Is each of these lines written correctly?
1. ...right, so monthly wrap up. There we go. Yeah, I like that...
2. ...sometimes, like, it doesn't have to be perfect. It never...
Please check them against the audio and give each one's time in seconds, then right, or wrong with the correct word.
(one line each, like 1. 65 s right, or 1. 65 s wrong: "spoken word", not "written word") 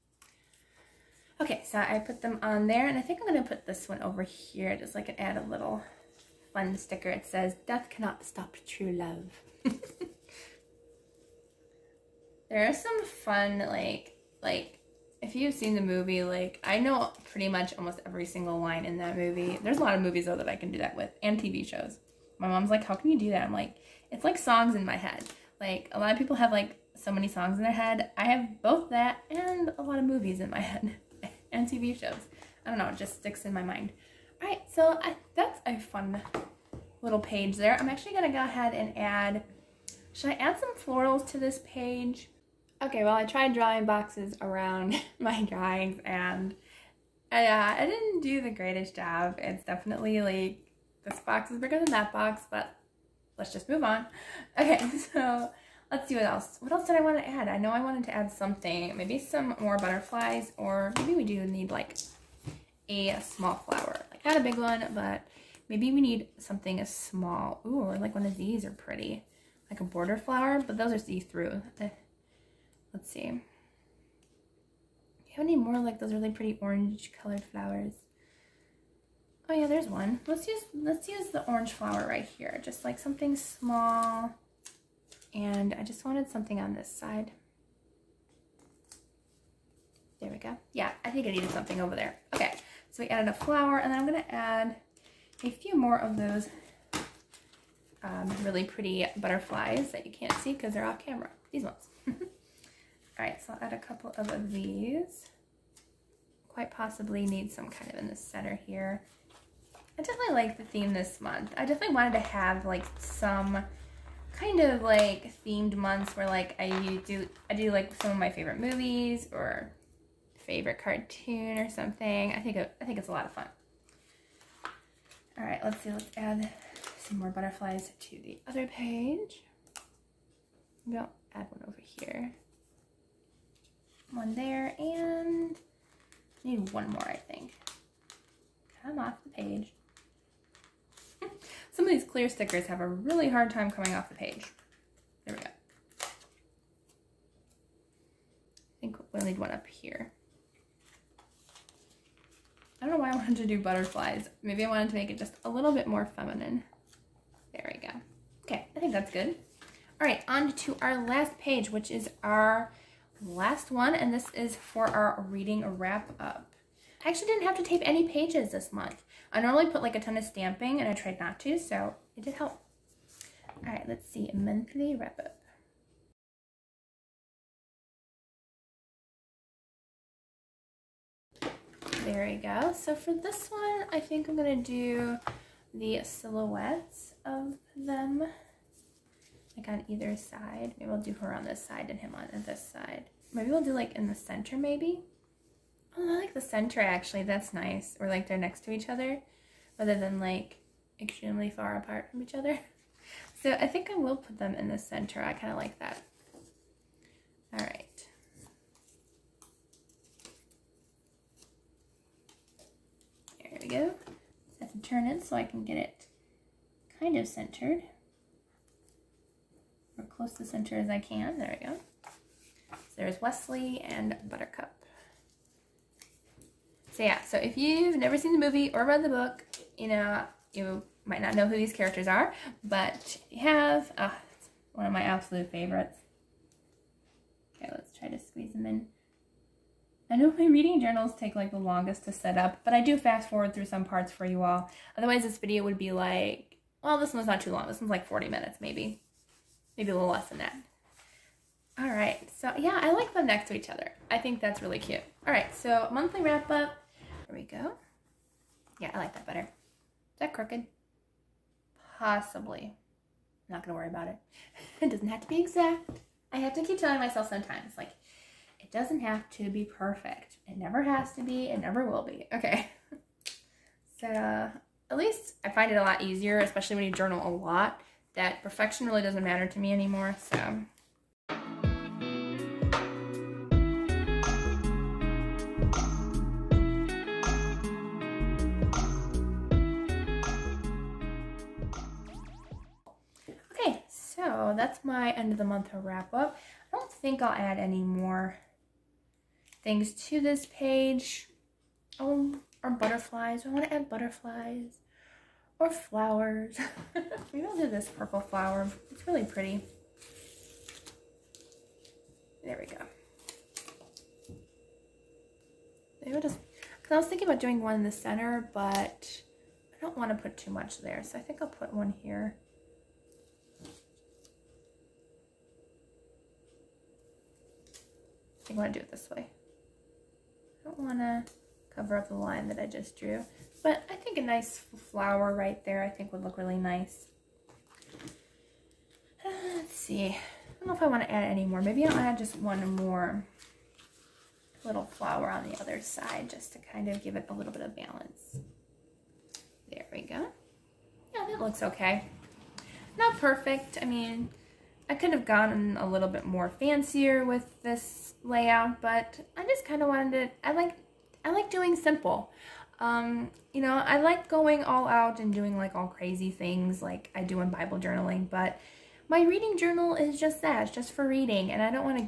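1. 255 s right
2. 267 s right.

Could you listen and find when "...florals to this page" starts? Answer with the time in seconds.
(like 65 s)
40 s.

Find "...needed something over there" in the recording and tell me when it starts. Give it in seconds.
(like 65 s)
91 s.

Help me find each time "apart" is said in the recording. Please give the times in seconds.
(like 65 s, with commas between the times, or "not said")
201 s.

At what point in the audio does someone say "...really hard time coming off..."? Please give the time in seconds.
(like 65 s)
142 s.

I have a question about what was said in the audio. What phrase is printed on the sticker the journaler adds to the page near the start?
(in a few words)
Death cannot stop true love.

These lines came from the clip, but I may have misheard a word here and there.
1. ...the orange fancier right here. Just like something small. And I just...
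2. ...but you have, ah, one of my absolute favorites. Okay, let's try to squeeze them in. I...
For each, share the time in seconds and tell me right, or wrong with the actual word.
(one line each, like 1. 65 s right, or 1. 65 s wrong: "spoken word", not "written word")
1. 81 s wrong: "flower", not "fancier"
2. 232 s right.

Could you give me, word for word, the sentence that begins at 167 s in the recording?
I actually didn't have to tape any pages this month.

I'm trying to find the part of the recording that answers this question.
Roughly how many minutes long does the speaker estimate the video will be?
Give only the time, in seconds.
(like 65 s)
248 s.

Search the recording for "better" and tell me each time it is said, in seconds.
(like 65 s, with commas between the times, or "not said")
259 s.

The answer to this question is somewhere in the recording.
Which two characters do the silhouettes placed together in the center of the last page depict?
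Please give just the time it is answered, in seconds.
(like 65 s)
223 s.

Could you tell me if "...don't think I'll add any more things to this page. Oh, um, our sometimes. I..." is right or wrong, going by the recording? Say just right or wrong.
wrong.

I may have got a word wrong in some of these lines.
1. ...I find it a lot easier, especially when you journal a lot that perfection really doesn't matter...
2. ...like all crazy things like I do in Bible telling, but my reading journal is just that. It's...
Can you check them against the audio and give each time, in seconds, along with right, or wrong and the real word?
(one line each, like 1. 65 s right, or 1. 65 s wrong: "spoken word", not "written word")
1. 275 s right
2. 365 s wrong: "journaling", not "telling".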